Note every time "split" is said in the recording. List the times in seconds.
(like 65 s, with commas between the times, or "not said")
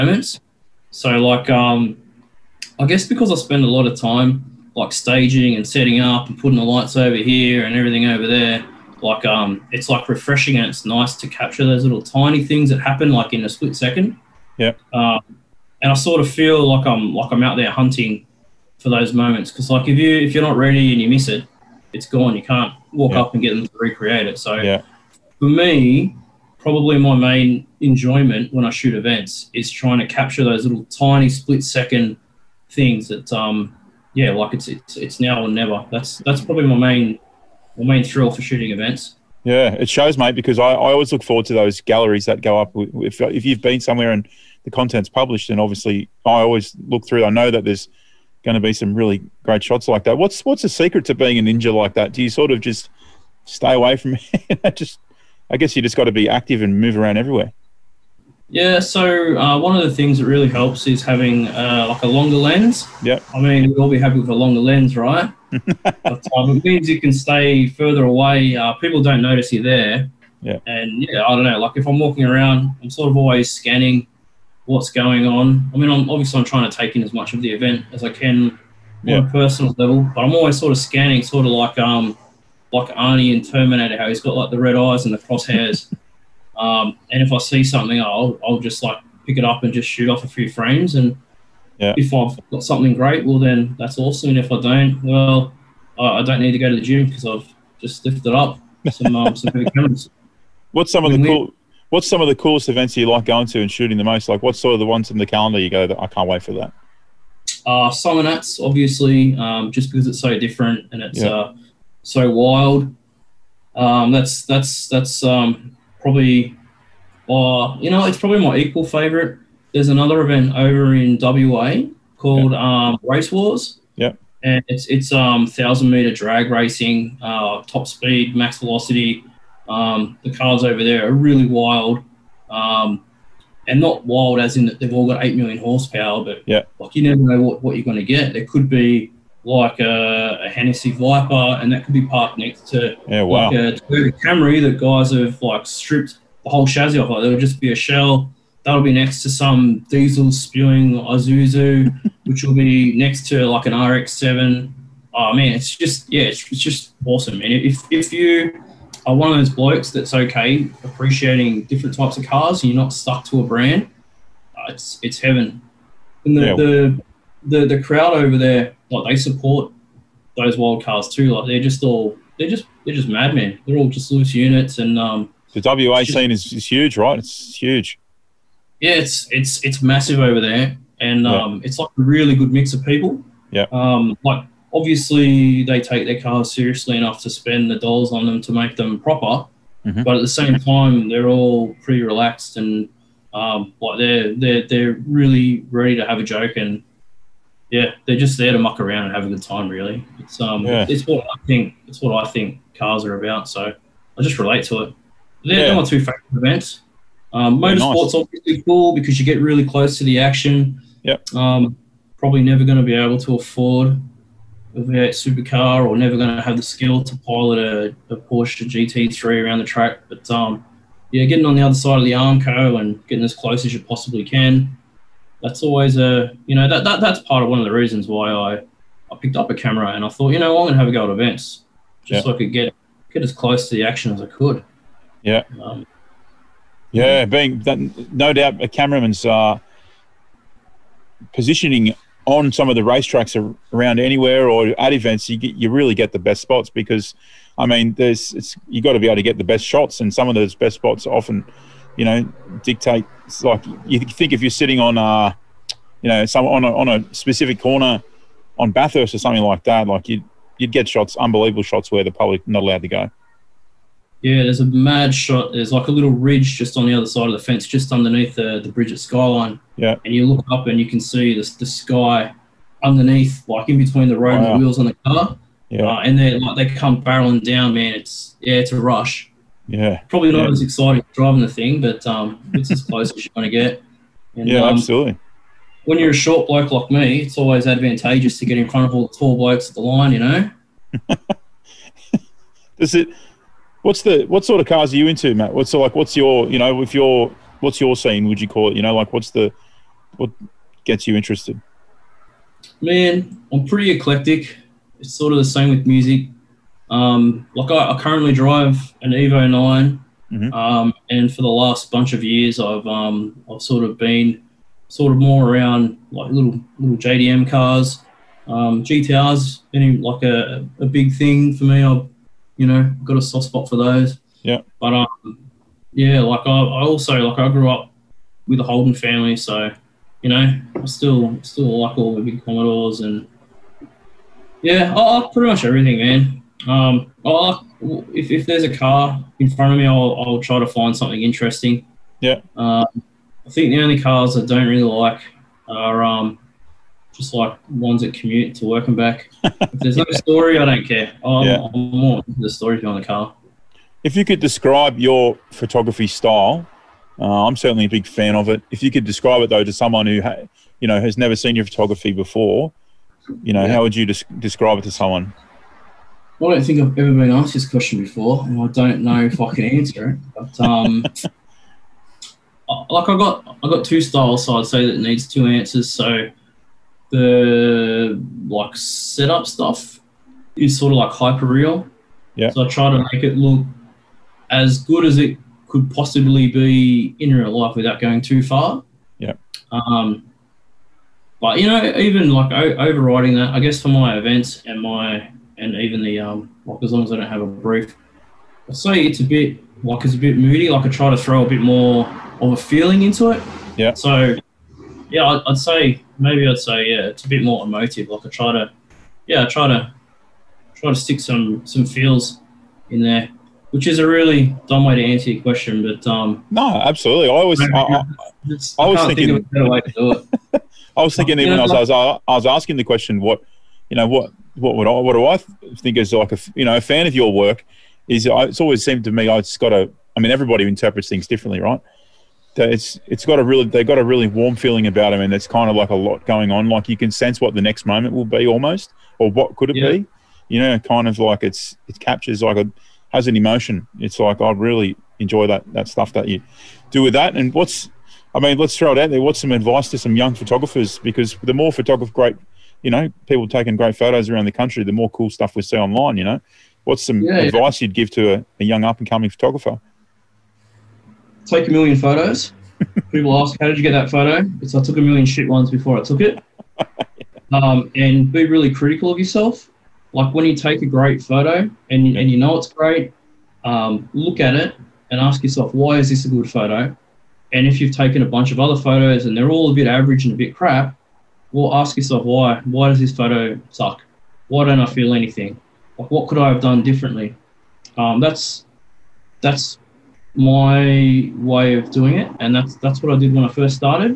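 13 s, 31 s.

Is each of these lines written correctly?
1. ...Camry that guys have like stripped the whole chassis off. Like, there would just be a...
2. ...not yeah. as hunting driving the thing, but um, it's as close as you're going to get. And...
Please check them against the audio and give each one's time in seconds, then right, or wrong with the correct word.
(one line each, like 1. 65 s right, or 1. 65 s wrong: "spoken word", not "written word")
1. 144 s right
2. 280 s wrong: "exciting", not "hunting".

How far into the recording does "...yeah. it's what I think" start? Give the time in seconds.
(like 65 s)
200 s.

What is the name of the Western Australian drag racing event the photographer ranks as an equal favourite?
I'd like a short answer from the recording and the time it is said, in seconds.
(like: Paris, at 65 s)
Race Wars, at 123 s.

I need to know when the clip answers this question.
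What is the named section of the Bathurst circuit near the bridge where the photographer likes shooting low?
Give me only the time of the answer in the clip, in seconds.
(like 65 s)
268 s.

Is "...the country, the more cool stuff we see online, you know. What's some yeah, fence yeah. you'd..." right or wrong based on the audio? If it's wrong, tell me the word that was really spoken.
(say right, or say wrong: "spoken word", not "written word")
wrong: "advice", not "fence".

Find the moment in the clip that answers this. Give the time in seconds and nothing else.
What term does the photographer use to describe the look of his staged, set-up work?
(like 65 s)
381 s.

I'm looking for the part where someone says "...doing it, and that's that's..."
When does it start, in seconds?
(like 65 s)
491 s.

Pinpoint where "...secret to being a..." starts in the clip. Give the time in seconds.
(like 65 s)
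50 s.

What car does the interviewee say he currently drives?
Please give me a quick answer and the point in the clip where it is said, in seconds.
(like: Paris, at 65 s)
Evo 9, at 309 s.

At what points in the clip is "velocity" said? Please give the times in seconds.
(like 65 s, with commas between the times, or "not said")
128 s.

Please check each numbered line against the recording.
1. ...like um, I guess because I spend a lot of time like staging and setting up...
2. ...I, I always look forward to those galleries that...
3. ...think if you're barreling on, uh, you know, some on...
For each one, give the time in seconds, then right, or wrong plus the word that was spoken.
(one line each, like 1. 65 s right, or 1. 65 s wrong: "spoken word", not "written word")
1. 1 s right
2. 40 s right
3. 253 s wrong: "sitting", not "barreling".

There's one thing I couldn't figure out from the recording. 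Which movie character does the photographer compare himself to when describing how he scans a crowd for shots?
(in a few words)
Arnie in Terminator.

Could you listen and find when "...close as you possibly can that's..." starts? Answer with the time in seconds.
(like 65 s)
223 s.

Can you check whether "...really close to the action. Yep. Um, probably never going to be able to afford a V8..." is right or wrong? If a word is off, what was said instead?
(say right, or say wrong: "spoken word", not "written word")
right.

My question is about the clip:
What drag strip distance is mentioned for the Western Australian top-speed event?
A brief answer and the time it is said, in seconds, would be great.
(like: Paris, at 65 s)
1000 meters, at 125 s.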